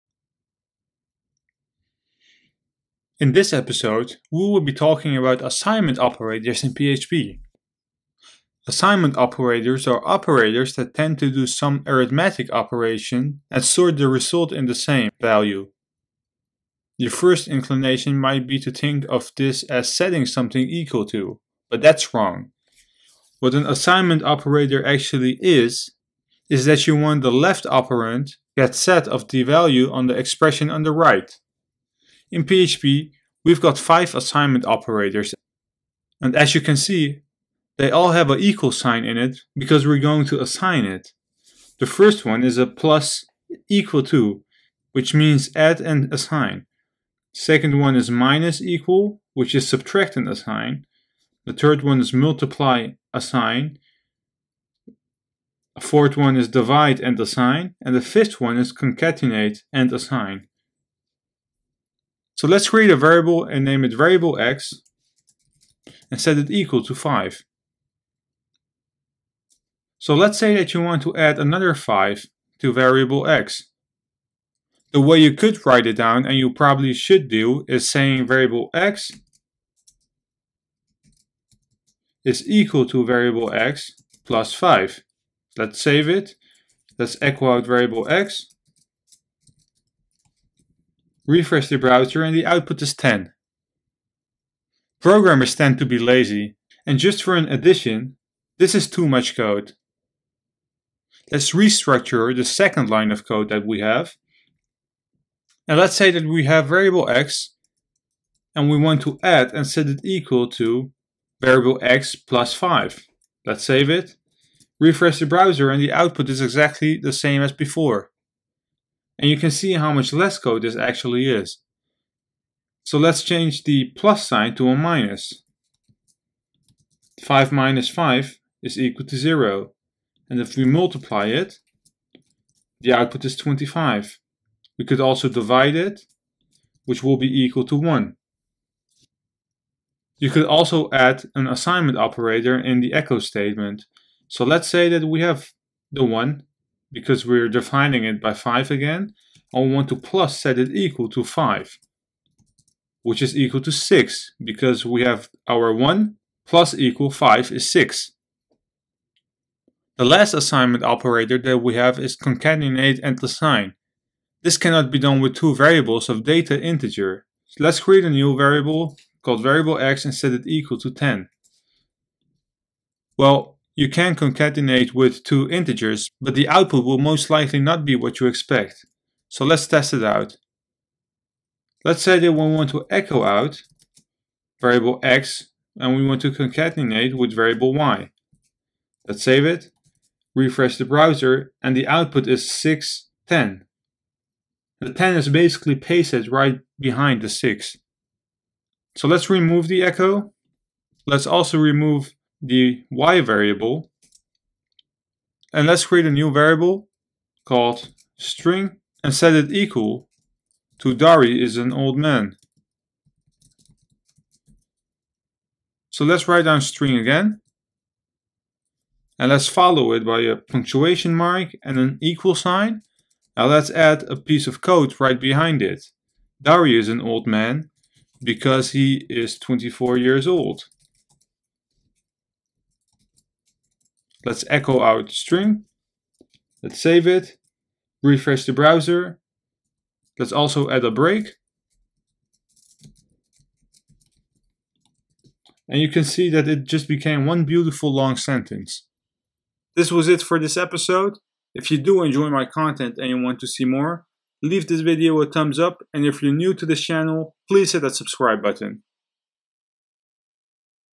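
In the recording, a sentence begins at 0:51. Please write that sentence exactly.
The third one is multiply assign.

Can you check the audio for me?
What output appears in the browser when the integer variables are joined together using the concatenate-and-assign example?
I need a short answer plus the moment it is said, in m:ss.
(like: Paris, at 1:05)
610, at 3:12.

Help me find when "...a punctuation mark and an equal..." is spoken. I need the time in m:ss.
3:40.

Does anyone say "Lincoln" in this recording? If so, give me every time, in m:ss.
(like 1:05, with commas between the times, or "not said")
not said.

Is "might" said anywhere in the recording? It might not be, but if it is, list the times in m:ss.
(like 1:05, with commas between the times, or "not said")
0:18.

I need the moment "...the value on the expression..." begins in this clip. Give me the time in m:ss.
0:29.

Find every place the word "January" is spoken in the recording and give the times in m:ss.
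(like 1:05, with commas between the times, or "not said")
not said.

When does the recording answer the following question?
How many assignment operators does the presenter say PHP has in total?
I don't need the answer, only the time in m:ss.
0:33.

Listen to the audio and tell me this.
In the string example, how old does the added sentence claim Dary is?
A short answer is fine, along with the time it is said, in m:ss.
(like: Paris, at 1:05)
24, at 3:49.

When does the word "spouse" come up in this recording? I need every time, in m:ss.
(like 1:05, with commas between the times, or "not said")
not said.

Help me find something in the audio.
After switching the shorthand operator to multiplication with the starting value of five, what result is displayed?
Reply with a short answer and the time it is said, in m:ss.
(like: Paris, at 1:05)
25, at 2:13.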